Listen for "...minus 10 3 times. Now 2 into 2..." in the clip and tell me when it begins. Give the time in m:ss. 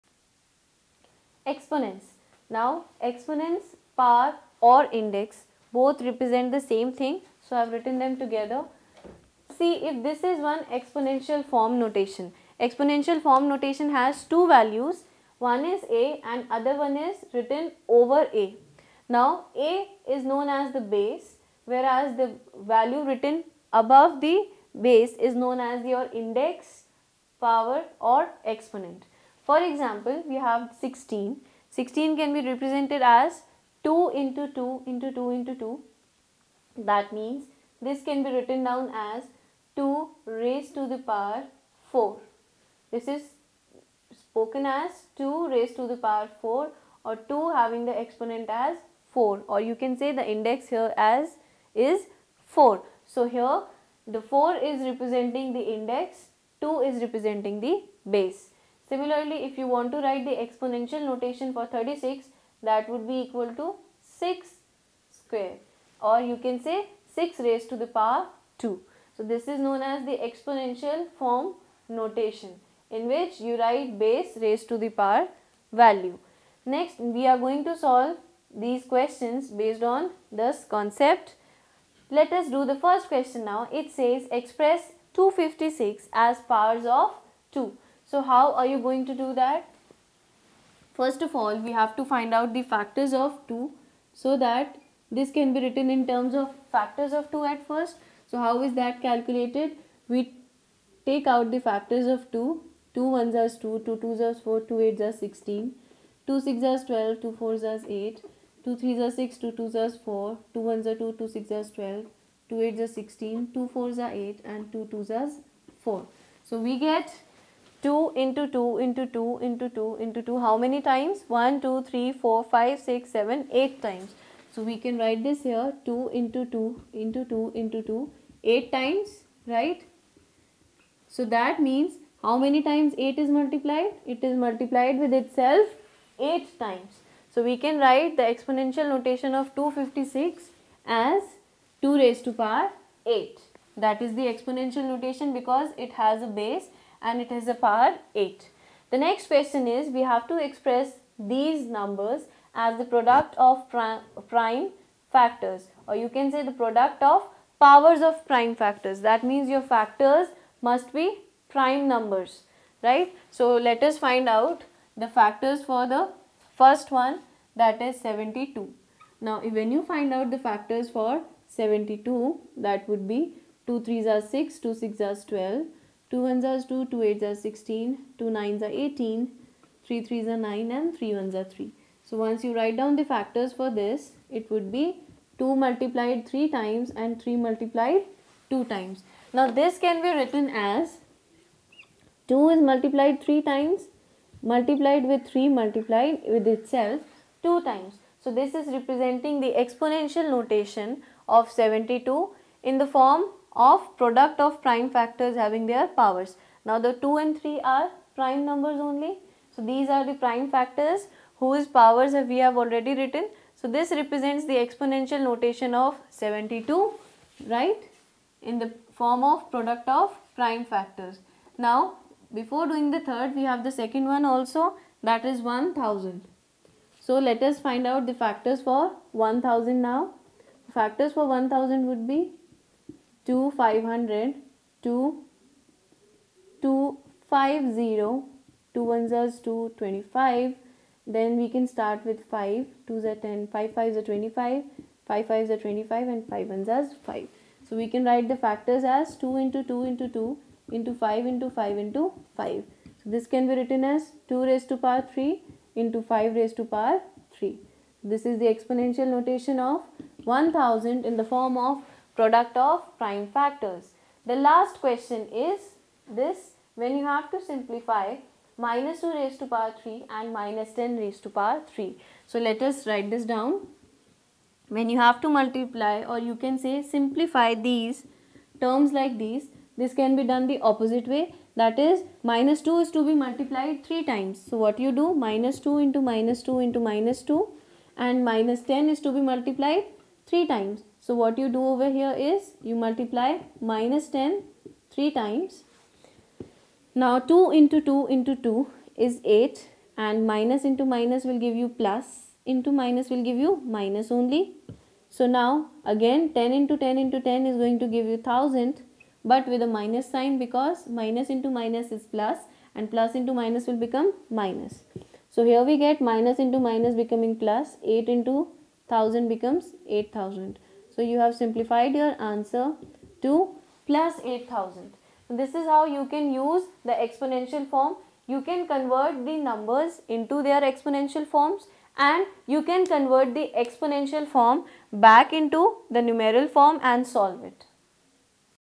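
4:53.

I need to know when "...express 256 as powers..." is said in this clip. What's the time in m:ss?
1:24.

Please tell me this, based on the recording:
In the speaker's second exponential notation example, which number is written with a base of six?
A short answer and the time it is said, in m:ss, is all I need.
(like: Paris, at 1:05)
36, at 1:01.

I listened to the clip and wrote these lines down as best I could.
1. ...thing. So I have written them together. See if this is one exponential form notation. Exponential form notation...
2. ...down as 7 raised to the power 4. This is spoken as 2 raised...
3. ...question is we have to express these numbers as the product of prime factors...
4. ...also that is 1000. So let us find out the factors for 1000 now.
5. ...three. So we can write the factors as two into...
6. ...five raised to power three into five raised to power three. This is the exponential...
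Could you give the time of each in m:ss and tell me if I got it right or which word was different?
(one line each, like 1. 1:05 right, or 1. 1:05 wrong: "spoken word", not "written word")
1. 0:07 right
2. 0:38 wrong: "2", not "7"
3. 2:29 right
4. 3:44 right
5. 4:07 wrong: "five", not "three"
6. 4:14 wrong: "two", not "five".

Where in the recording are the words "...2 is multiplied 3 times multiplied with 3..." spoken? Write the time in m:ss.
3:12.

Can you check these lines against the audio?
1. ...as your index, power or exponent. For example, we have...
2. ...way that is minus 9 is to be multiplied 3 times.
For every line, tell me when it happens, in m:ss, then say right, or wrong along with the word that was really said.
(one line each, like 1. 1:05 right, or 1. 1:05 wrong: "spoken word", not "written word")
1. 0:25 right
2. 4:41 wrong: "2", not "9".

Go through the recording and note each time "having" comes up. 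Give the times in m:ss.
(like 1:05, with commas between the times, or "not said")
0:47, 3:25.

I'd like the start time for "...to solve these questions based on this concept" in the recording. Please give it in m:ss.
1:17.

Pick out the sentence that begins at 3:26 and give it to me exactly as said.
Now the 2 and 3 are prime numbers only.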